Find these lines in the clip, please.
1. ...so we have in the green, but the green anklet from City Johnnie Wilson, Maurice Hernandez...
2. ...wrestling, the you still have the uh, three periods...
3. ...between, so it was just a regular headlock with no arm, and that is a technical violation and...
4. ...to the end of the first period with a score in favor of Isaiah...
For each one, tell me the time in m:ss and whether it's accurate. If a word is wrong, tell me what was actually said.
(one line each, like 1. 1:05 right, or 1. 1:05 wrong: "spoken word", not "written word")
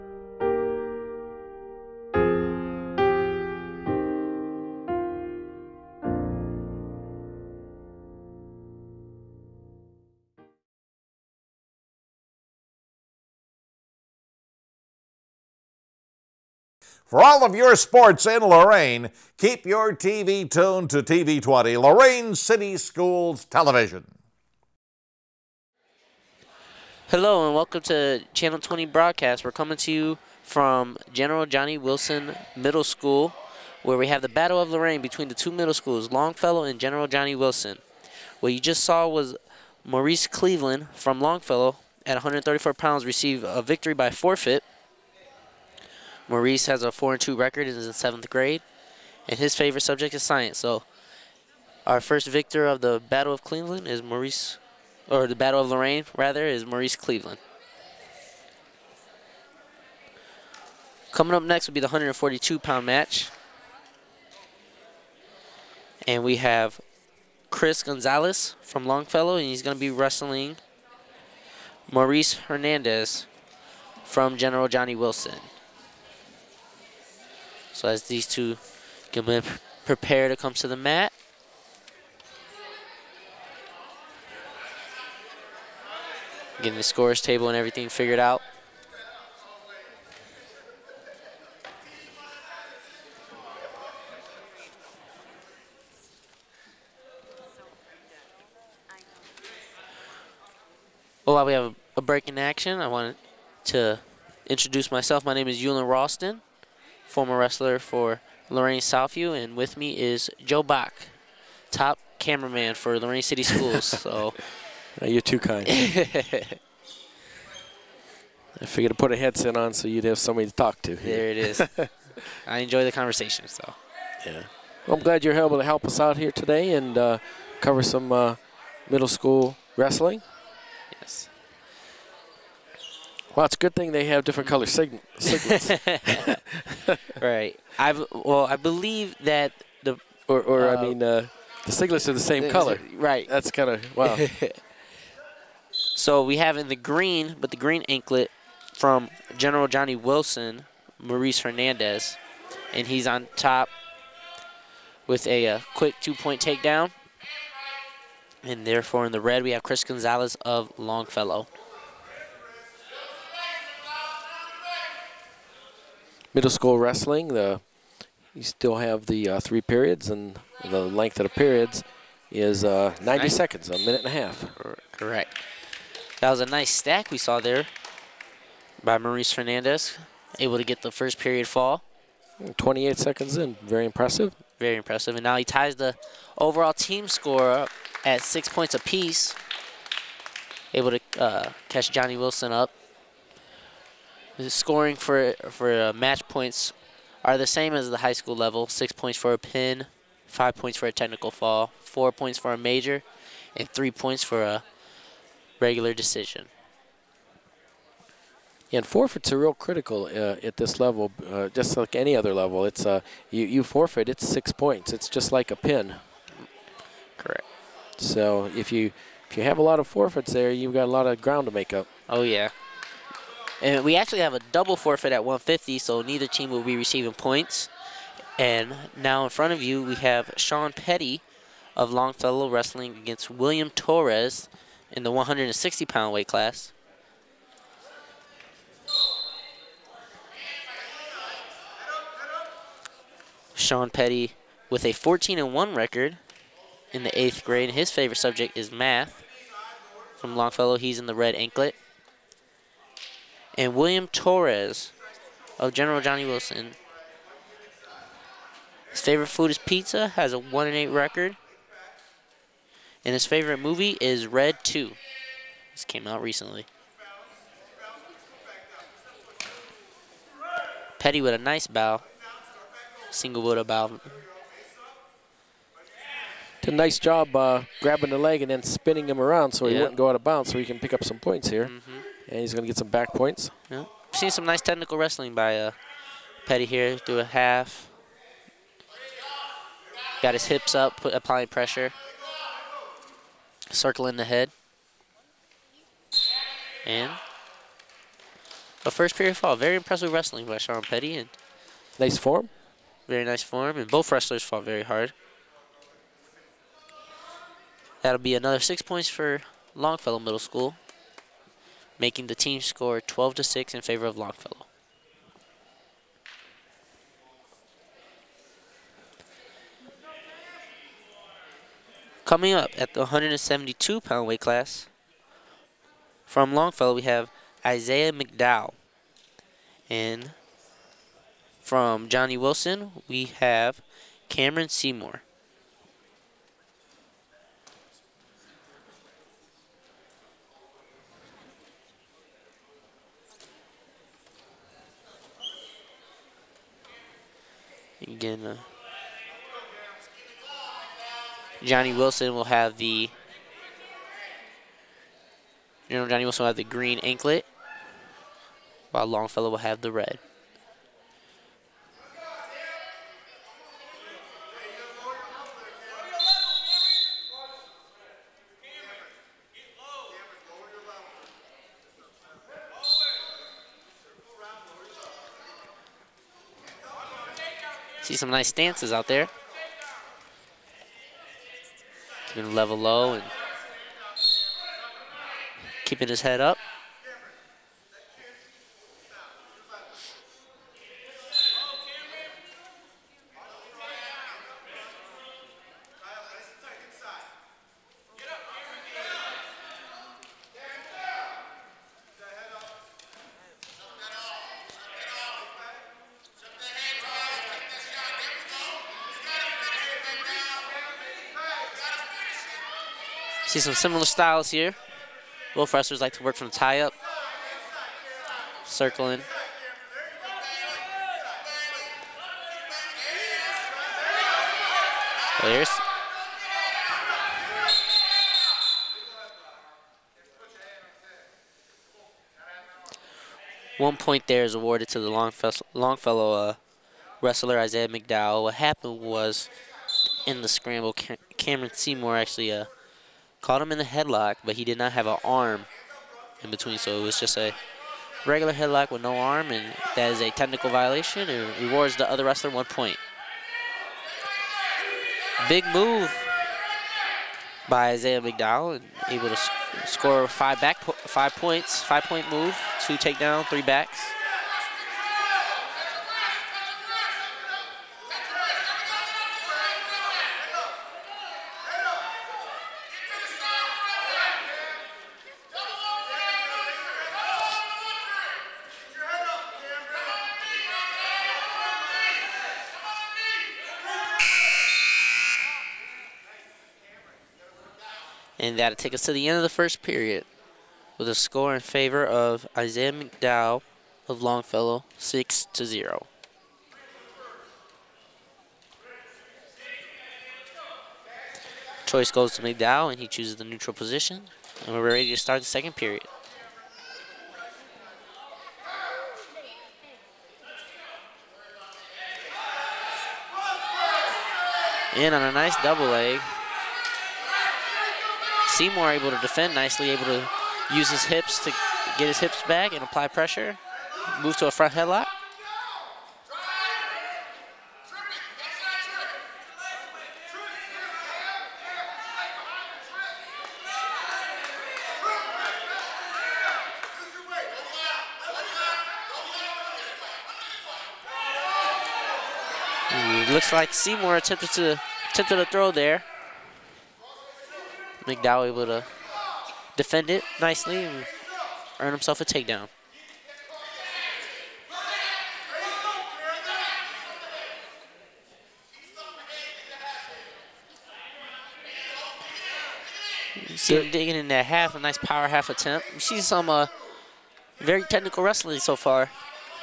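1. 2:25 wrong: "General", not "City"
2. 2:46 right
3. 7:26 right
4. 8:09 right.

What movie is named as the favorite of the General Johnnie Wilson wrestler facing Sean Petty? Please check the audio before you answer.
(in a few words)
Red 2.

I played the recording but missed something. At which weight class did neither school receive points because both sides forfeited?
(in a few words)
150.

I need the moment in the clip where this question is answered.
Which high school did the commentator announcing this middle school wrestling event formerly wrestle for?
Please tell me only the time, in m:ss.
1:48.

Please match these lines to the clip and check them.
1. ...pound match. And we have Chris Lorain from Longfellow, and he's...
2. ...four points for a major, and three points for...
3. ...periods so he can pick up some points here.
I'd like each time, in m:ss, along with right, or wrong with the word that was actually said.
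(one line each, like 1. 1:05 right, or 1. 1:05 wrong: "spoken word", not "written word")
1. 1:02 wrong: "Gonzalez", not "Lorain"
2. 3:21 right
3. 4:40 wrong: "bounds", not "periods".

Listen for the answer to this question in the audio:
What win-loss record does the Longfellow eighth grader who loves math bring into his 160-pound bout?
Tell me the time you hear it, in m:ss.
4:04.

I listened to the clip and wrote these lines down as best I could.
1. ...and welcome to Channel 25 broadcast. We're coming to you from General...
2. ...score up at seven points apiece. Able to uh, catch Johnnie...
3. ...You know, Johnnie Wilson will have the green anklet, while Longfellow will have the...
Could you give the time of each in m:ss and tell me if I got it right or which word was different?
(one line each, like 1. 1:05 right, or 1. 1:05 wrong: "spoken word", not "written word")
1. 0:27 wrong: "20", not "25"
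2. 3:07 wrong: "six", not "seven"
3. 5:55 right.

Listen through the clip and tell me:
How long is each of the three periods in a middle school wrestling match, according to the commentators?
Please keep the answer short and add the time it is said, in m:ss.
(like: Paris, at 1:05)
90 seconds, at 2:53.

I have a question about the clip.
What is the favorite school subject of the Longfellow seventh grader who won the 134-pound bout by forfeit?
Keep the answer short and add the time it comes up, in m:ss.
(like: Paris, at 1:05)
science, at 0:50.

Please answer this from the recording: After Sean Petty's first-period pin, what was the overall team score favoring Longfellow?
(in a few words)
12 to 6.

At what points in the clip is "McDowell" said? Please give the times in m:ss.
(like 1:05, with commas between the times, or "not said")
5:28, 7:17, 7:38, 8:12, 8:22, 9:08.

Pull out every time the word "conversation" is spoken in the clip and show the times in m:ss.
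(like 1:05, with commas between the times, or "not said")
2:02.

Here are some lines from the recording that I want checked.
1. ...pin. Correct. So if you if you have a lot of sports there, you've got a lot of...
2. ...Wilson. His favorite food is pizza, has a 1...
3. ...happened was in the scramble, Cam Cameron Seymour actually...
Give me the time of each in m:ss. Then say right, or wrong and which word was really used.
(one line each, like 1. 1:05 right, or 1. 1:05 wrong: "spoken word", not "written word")
1. 3:35 wrong: "forfeits", not "sports"
2. 4:16 right
3. 7:18 right.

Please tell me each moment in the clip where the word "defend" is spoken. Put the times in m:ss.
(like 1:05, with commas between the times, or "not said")
8:39, 9:09.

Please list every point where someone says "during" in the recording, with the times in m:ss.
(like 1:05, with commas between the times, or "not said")
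not said.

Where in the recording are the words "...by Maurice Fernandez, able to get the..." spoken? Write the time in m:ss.
2:58.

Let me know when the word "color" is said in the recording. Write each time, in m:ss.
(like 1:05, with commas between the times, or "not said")
2:14, 2:22.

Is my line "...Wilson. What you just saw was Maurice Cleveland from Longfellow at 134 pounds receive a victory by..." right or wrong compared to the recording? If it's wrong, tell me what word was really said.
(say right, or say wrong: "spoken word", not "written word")
right.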